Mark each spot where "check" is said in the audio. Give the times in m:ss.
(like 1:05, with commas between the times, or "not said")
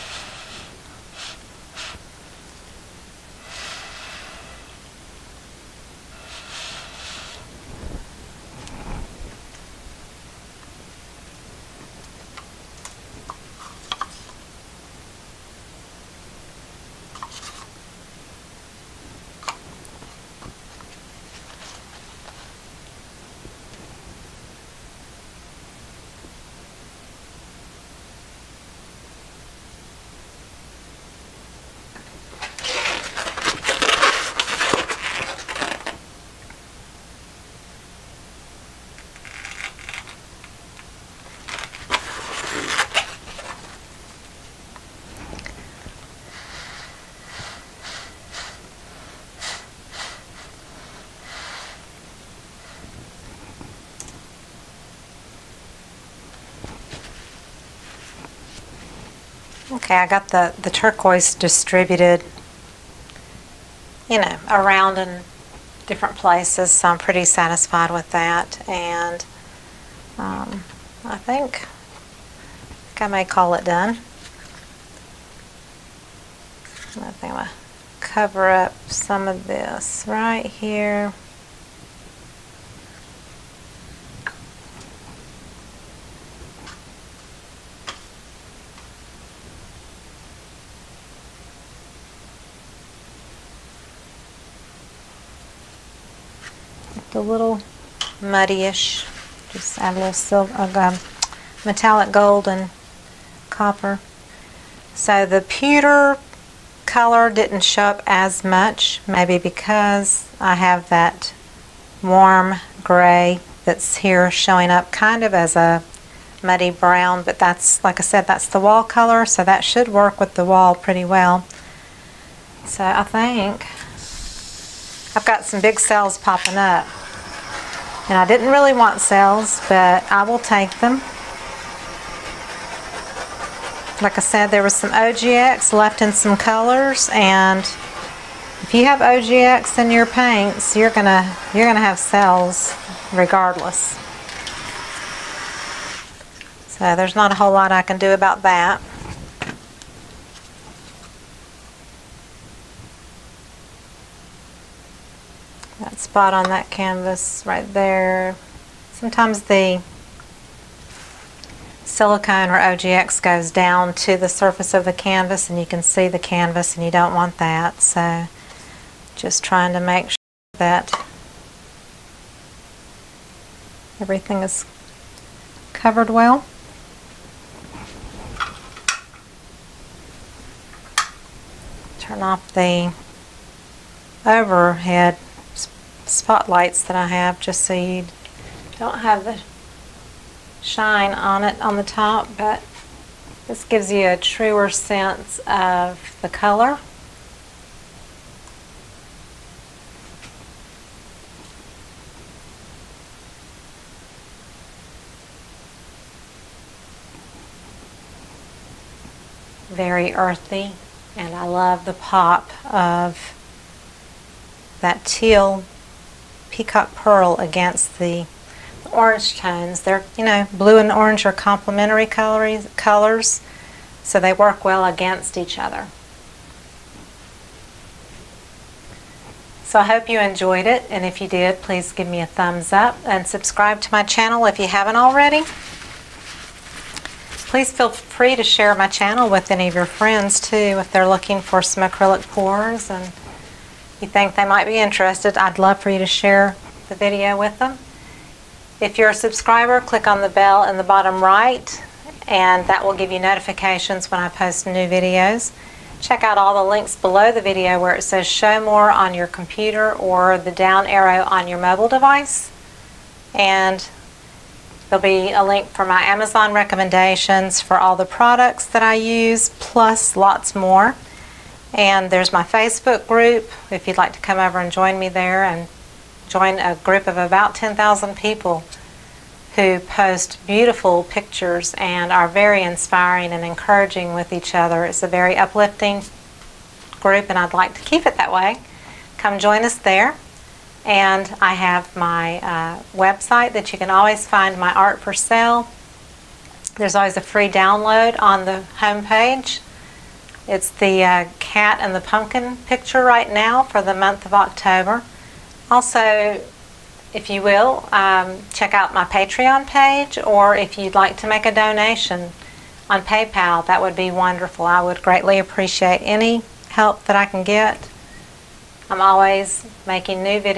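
4:16, 5:08.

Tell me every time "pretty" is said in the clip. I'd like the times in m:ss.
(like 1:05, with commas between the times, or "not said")
1:06, 2:00.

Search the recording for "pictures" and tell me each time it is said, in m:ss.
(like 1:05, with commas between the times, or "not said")
4:41, 5:02.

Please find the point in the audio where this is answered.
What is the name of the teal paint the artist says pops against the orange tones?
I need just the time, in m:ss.
3:36.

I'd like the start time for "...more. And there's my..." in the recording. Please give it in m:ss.
4:30.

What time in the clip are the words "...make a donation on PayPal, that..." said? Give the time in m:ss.
5:11.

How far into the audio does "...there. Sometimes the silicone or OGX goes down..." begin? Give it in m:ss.
2:37.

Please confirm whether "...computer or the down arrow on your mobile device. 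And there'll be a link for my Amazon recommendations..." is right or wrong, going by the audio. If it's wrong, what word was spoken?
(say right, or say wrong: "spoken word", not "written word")
right.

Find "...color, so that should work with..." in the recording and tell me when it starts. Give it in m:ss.
1:58.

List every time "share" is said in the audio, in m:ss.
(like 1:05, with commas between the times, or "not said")
3:58, 4:06.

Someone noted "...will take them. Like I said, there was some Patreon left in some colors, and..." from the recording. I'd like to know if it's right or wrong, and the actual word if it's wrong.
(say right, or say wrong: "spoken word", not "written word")
wrong: "OGX", not "Patreon".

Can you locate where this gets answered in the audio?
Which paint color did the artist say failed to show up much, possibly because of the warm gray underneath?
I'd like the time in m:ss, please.
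1:45.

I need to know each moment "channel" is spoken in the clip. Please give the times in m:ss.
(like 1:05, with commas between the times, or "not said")
3:54, 3:58.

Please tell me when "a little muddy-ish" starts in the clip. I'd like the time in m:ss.
1:37.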